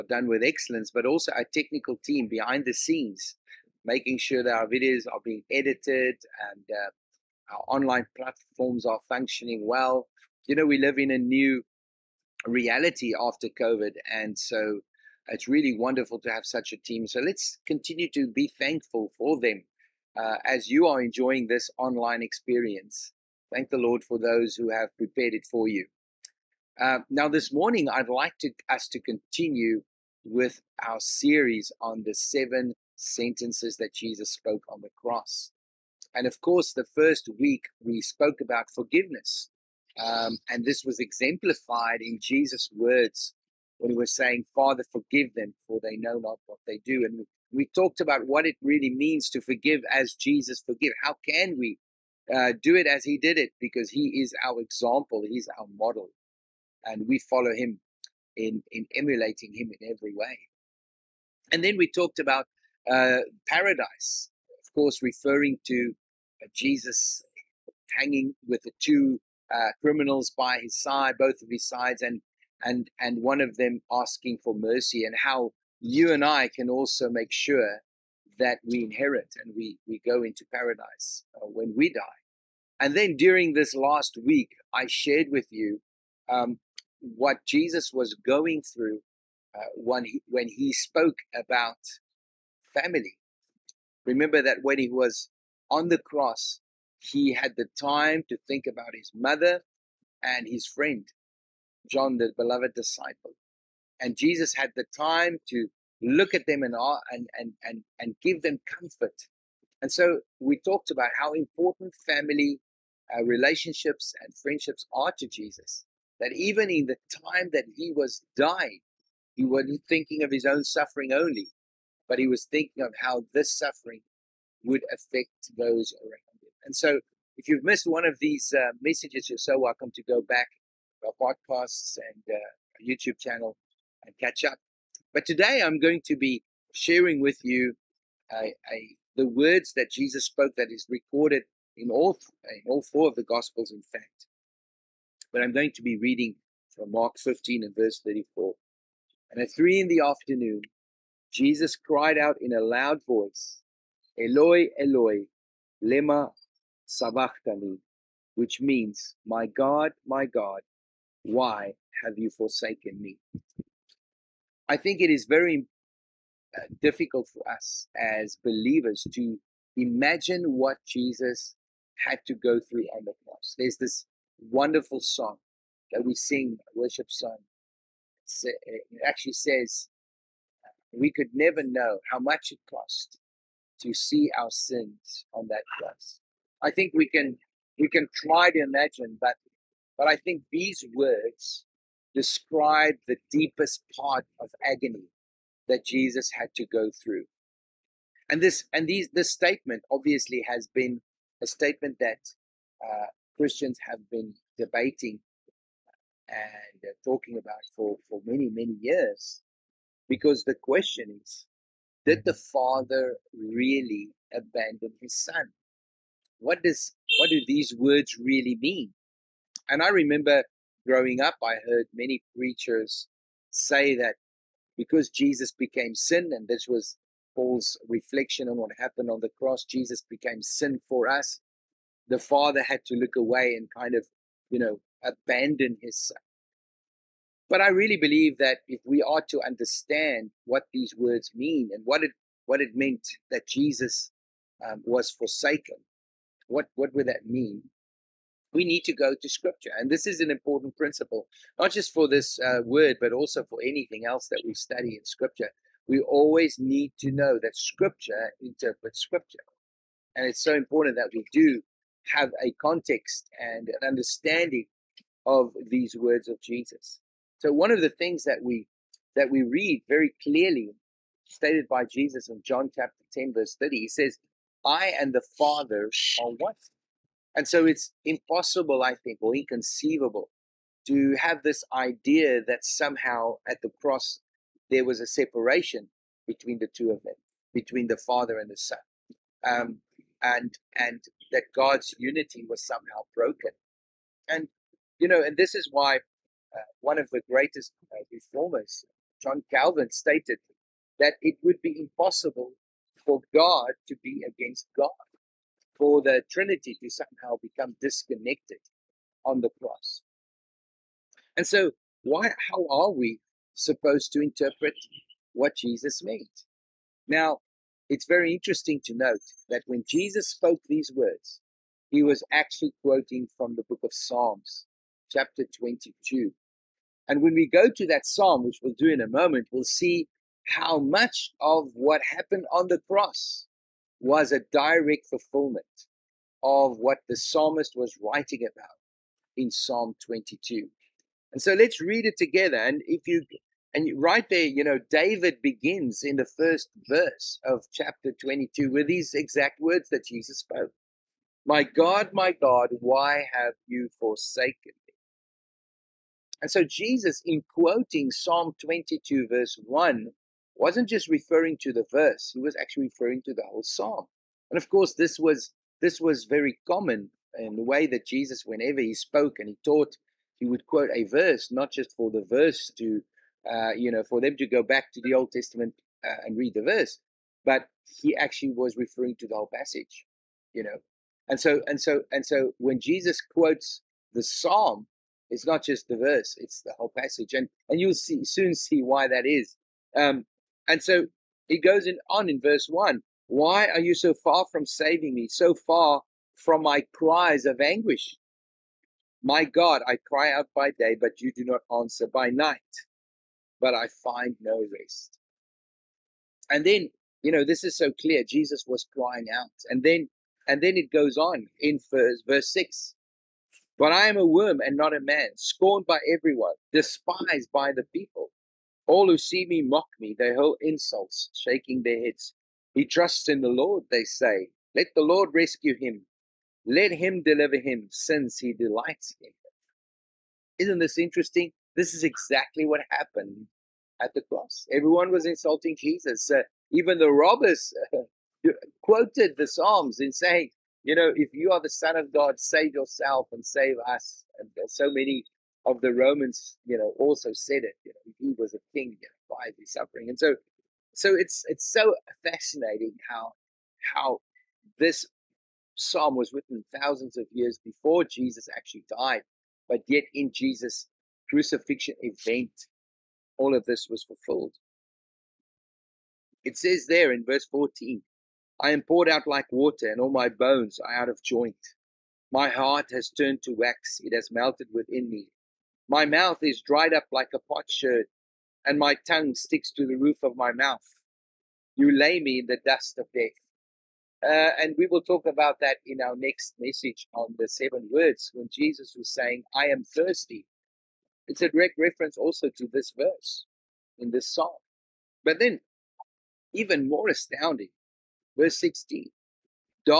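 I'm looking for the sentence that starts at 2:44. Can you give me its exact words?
I think it is very uh, difficult for us as believers to imagine what Jesus had to go through on the cross.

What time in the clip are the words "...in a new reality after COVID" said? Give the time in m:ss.
0:10.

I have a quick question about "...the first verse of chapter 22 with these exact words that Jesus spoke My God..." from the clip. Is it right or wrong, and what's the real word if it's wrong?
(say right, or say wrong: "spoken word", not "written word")
right.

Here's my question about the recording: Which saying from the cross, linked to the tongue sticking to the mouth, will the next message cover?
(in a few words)
I am thirsty.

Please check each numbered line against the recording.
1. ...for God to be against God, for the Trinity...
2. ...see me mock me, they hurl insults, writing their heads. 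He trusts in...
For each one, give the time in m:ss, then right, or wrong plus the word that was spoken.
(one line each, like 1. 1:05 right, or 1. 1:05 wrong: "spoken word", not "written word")
1. 5:03 right
2. 6:59 wrong: "shaking", not "writing".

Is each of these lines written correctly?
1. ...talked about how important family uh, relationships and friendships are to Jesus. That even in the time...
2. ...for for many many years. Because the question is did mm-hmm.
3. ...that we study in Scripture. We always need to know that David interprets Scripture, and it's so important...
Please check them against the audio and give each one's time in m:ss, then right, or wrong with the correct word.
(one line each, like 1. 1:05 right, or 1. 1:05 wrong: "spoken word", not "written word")
1. 1:50 right
2. 3:27 right
3. 4:14 wrong: "Scripture", not "David".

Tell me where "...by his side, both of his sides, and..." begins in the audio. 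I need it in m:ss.
1:10.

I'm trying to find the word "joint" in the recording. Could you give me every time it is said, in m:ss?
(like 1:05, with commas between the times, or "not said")
7:51.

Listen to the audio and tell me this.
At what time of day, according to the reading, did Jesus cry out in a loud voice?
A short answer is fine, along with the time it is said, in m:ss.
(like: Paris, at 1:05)
three in the afternoon, at 2:29.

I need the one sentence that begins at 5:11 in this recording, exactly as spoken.
And so, why, how are we supposed to interpret what Jesus meant?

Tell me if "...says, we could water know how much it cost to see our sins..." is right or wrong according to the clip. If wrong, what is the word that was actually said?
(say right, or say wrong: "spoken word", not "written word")
wrong: "never", not "water".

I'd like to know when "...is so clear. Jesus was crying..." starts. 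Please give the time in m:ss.
6:47.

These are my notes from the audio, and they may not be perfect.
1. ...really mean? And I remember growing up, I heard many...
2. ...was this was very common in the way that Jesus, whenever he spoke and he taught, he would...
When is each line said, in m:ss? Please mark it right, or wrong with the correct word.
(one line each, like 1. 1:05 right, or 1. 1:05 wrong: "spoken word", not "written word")
1. 3:38 right
2. 6:05 right.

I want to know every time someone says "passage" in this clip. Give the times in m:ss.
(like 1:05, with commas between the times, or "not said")
6:19, 6:26.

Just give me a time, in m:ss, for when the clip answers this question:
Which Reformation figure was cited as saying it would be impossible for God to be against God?
4:59.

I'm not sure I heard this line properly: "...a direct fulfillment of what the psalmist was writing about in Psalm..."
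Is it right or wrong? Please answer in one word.
right.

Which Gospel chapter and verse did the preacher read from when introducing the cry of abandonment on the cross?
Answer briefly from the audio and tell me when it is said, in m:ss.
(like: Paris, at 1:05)
Mark 15:34, at 2:26.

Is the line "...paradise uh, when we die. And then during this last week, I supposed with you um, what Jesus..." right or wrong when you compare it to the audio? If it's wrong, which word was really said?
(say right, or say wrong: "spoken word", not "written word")
wrong: "shared", not "supposed".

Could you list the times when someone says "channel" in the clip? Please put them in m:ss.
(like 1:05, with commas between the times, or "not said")
2:13.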